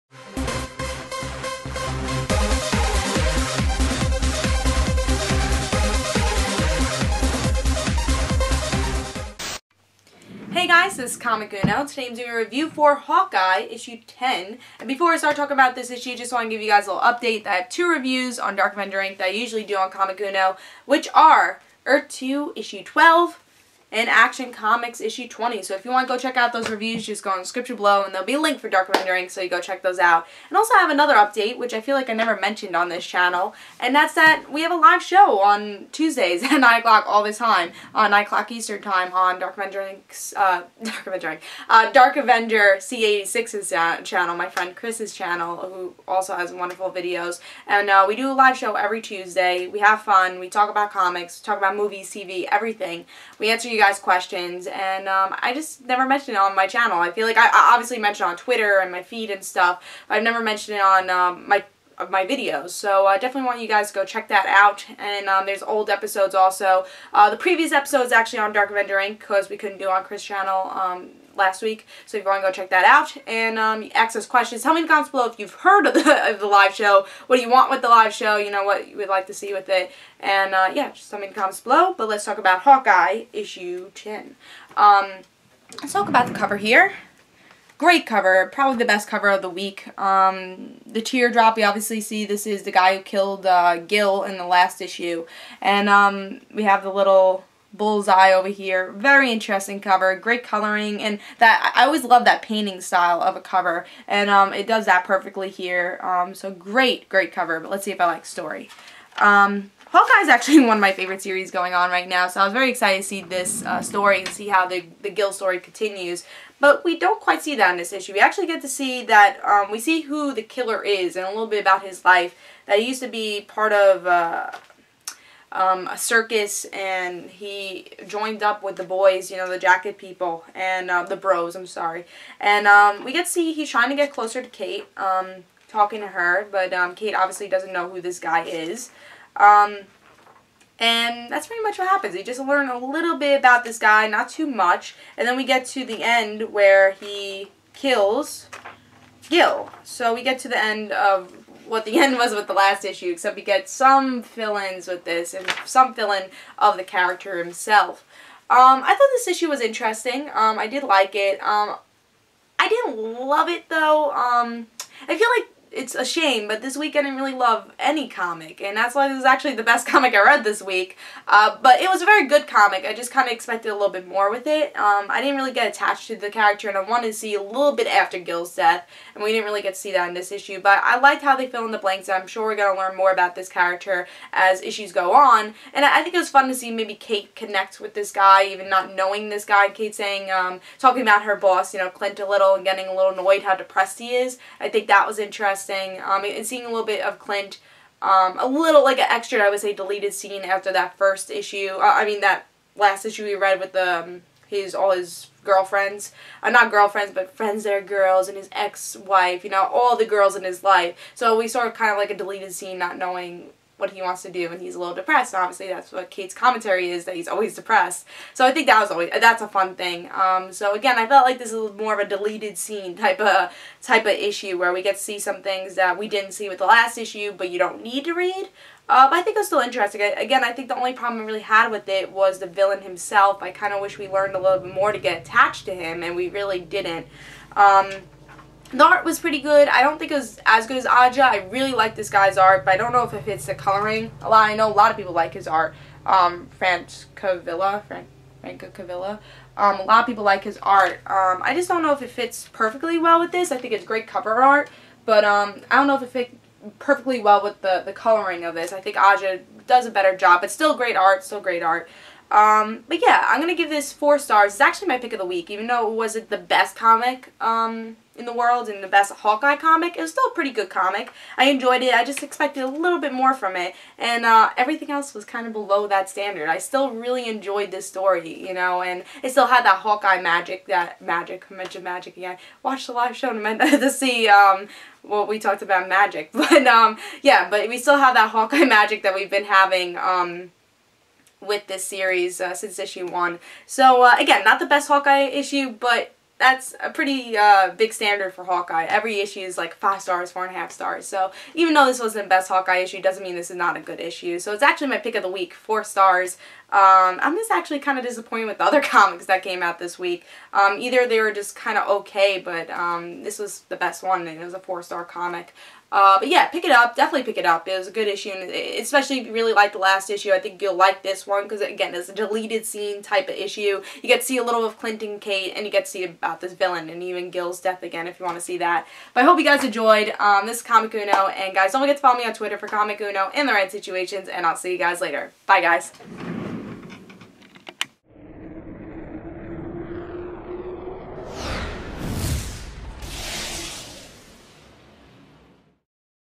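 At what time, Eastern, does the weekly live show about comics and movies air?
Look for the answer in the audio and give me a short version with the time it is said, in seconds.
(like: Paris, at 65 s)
9 o'clock, at 38 s.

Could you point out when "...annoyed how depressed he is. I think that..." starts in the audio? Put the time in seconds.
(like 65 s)
193 s.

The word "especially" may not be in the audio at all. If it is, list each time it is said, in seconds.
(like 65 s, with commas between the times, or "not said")
318 s.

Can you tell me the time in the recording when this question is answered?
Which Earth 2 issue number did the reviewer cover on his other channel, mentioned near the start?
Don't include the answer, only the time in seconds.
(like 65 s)
22 s.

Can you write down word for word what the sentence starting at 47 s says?
And uh, we do a live show every Tuesday.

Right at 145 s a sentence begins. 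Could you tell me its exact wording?
And then we get to the end where he kills Gil.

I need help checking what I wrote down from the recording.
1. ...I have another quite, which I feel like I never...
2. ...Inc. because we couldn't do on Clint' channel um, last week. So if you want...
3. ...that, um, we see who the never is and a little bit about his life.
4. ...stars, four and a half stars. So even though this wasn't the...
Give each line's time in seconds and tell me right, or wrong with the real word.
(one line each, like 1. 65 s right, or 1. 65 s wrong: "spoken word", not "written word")
1. 30 s wrong: "update", not "quite"
2. 68 s wrong: "Chris", not "Clint"
3. 119 s wrong: "killer", not "never"
4. 300 s right.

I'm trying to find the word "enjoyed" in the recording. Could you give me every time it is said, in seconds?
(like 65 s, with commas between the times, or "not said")
271 s, 277 s, 329 s.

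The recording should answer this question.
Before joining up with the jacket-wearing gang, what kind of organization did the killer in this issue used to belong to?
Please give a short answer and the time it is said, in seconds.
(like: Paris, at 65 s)
A circus, at 125 s.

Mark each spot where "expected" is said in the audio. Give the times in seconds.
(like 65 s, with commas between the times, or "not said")
173 s, 272 s.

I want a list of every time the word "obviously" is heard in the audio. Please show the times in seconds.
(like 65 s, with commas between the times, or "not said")
57 s, 91 s, 137 s, 215 s.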